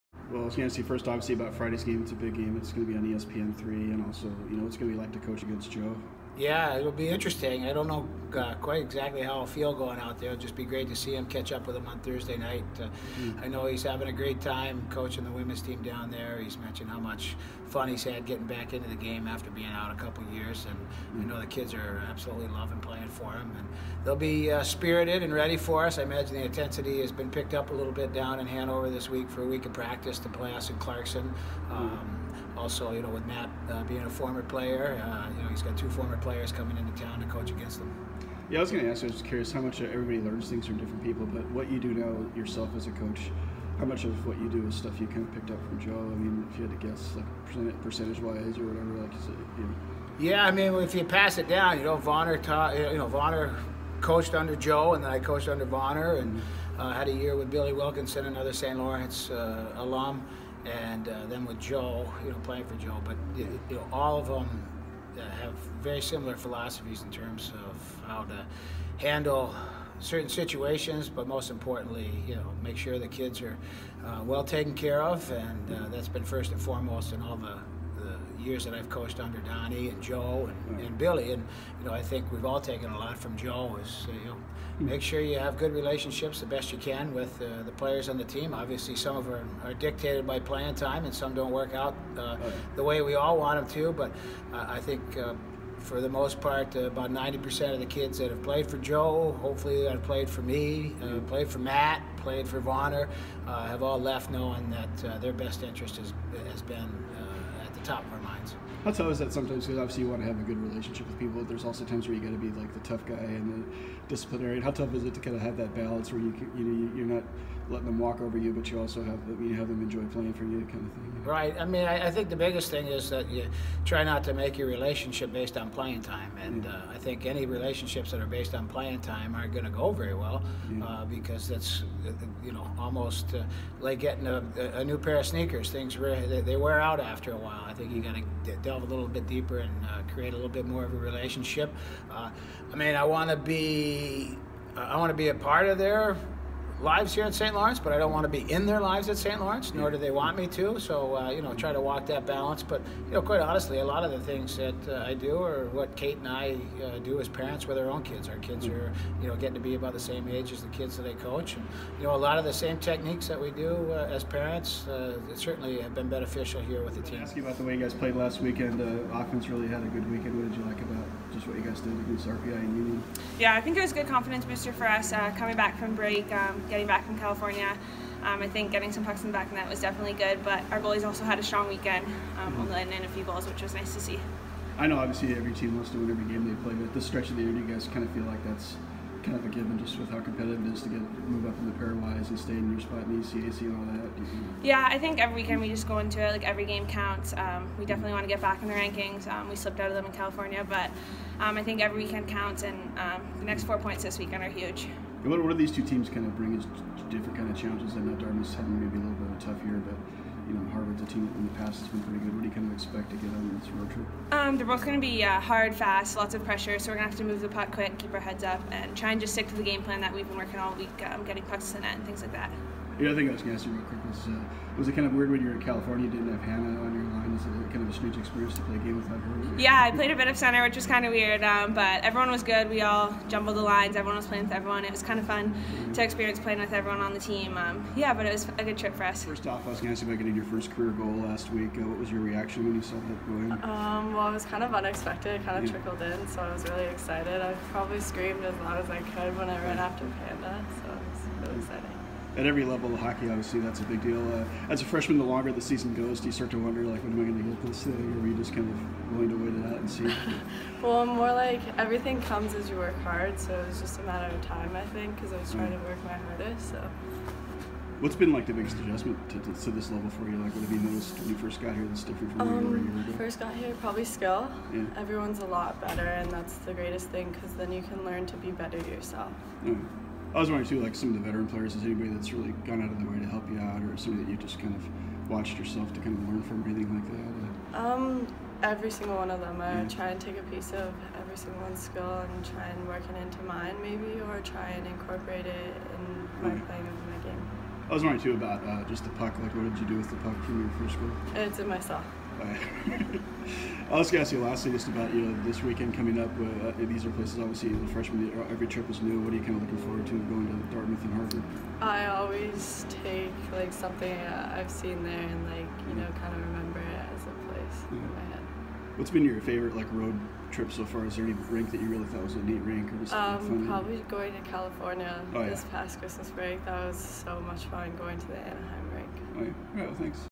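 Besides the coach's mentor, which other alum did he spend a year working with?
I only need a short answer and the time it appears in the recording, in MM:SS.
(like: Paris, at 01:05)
Billy Wilkinson, at 00:57.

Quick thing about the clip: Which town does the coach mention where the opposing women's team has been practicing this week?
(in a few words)
Hanover.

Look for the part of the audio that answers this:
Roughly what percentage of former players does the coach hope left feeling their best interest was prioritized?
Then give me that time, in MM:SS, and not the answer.
01:37.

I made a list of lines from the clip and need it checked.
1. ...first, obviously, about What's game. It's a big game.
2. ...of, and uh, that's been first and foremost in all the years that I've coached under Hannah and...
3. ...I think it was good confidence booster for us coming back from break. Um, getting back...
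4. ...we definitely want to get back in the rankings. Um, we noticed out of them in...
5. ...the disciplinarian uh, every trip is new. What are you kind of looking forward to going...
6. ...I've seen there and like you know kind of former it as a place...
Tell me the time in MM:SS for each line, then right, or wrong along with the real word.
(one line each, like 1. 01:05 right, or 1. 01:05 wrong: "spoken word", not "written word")
1. 00:00 wrong: "Friday", not "What"
2. 01:15 wrong: "Donnie", not "Hannah"
3. 02:53 right
4. 03:17 wrong: "slipped", not "noticed"
5. 05:07 wrong: "freshman", not "disciplinarian"
6. 05:14 wrong: "remember", not "former".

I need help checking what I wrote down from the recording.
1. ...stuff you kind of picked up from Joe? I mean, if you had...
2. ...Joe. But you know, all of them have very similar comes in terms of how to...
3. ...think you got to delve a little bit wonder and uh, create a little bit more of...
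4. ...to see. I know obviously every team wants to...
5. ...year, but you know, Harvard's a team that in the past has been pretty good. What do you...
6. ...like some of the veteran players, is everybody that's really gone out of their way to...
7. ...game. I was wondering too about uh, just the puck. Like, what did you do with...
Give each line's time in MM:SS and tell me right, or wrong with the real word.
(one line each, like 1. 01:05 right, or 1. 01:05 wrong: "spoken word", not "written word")
1. 00:44 right
2. 01:02 wrong: "philosophies", not "comes"
3. 02:17 wrong: "deeper", not "wonder"
4. 03:03 right
5. 03:29 right
6. 04:40 wrong: "anybody", not "everybody"
7. 04:57 right.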